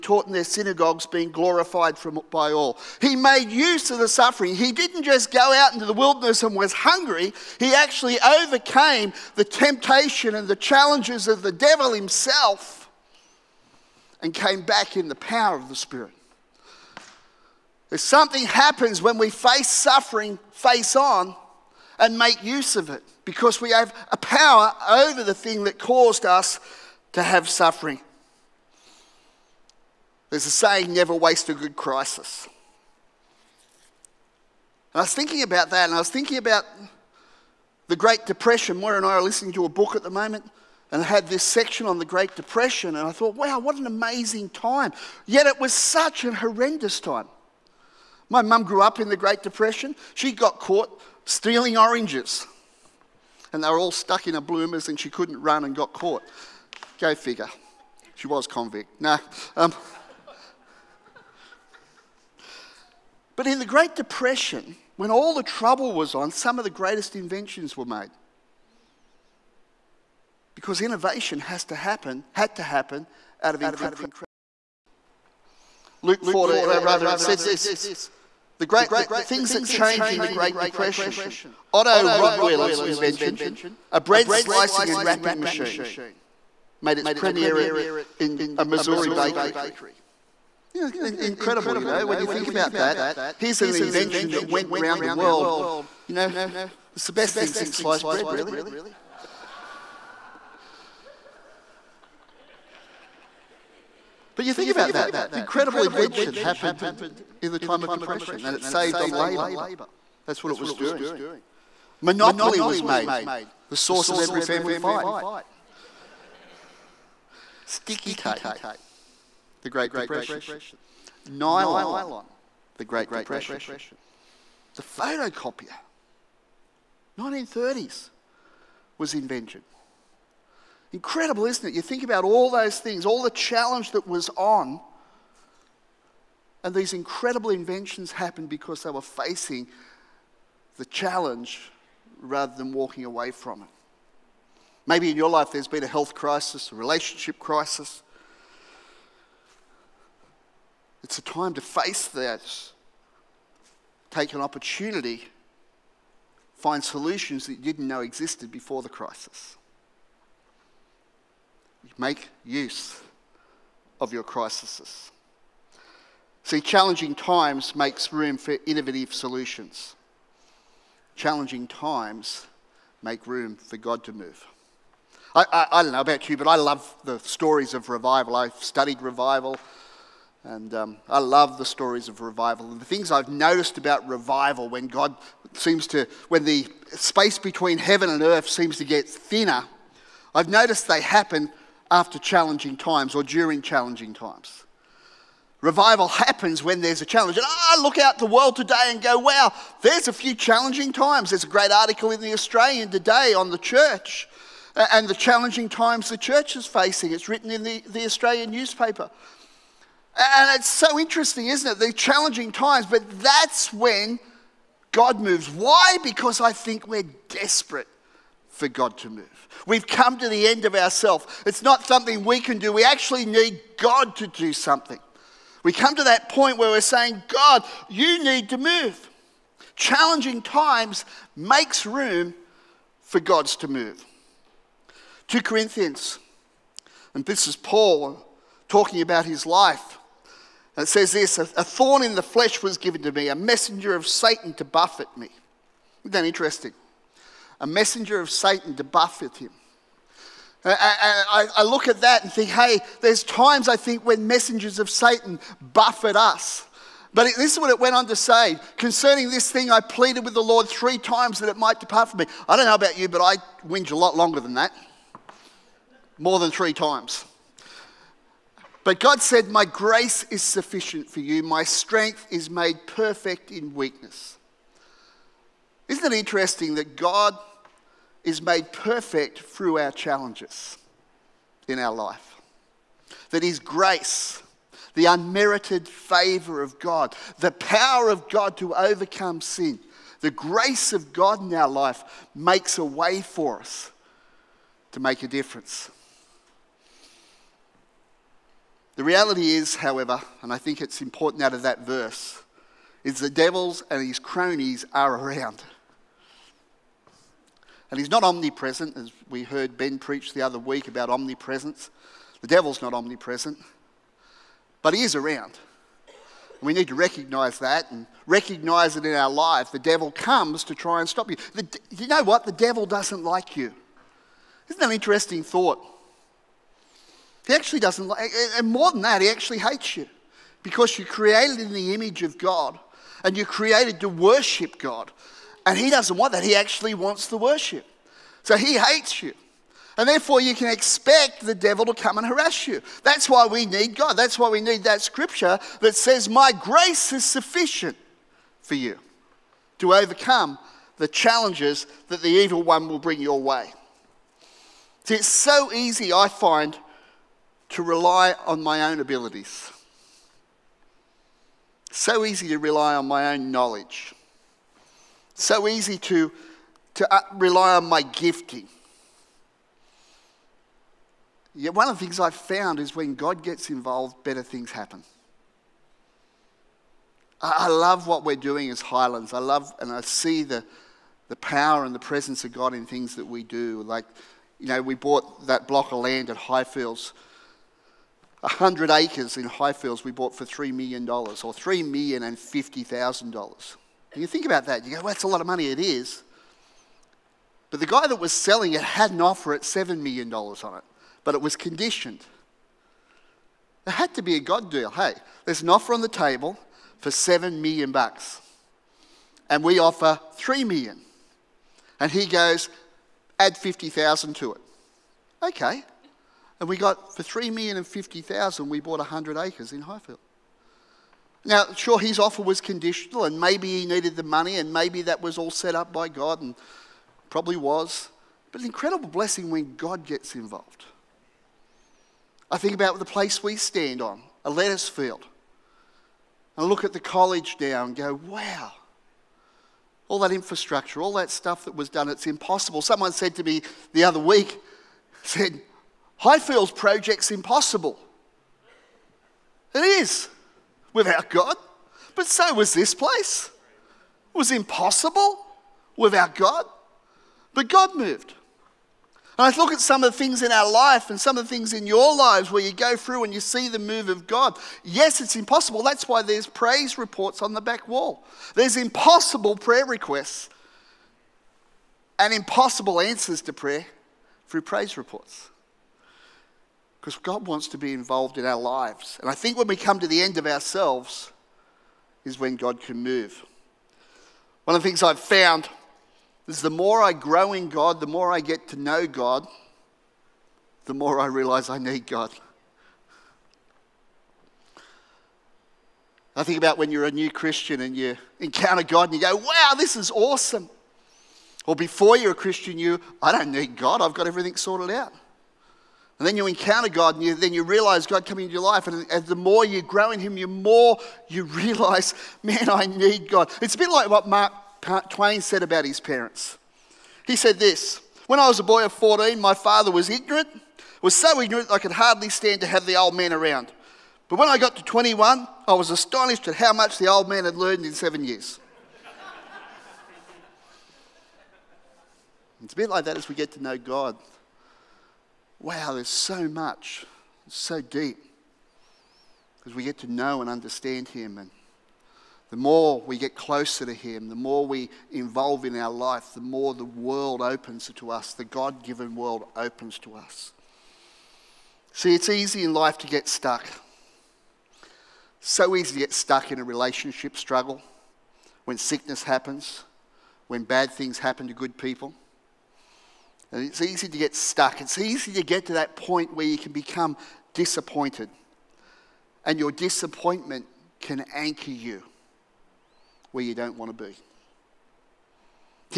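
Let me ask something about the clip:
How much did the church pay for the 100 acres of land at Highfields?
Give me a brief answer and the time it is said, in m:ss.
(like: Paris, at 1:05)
$3,050,000, at 6:31.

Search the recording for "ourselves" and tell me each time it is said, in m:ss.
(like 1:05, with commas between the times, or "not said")
3:40, 8:00.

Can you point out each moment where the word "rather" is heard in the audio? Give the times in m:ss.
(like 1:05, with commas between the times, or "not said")
1:16, 2:22.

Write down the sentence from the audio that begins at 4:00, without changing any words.
It says this a thorn in the flesh was given to me, a messenger of Satan to buffet me.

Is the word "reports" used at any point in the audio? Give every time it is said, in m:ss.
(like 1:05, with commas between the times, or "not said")
7:46, 7:54.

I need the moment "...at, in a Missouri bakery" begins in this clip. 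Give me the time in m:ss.
1:27.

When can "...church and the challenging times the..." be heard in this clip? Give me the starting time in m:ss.
3:23.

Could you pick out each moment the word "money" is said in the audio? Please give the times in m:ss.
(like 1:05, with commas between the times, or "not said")
6:35, 7:04.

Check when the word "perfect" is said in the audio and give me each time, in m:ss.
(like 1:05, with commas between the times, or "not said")
4:32, 4:38.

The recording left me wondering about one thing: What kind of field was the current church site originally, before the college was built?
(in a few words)
Lettuce field.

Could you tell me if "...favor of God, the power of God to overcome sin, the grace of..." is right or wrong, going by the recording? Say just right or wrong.
right.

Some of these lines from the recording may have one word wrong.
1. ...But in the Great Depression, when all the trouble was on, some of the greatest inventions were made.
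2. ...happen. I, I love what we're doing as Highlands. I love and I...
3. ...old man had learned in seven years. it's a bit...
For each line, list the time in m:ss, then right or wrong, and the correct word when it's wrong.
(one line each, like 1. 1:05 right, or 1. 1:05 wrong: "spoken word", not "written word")
1. 1:03 right
2. 6:14 right
3. 8:47 right.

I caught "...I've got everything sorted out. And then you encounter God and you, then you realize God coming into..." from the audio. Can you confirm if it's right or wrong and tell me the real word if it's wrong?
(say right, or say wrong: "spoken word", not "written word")
right.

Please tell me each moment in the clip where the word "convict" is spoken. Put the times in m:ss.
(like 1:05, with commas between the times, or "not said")
0:58.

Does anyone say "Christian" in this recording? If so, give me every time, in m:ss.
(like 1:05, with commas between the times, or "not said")
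8:17, 8:22.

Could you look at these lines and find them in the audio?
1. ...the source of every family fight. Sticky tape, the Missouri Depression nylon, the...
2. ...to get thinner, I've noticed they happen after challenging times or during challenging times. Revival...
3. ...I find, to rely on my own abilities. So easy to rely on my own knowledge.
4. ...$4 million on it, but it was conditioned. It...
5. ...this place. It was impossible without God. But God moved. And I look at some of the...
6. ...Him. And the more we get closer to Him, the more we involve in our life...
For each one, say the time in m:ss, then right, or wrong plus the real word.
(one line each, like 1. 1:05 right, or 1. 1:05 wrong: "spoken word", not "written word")
1. 1:53 wrong: "Great", not "Missouri"
2. 3:08 right
3. 5:56 right
4. 6:39 wrong: "7", not "4"
5. 7:32 right
6. 9:01 right.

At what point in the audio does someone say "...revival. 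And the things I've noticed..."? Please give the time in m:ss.
3:02.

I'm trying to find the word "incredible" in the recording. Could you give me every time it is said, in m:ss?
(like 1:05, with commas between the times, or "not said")
1:13, 1:31, 1:45, 2:10, 2:16, 7:08.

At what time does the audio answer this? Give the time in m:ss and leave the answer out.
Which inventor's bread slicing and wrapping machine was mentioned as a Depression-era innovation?
1:21.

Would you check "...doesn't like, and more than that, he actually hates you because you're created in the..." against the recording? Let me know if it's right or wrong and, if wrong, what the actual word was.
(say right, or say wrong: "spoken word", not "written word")
right.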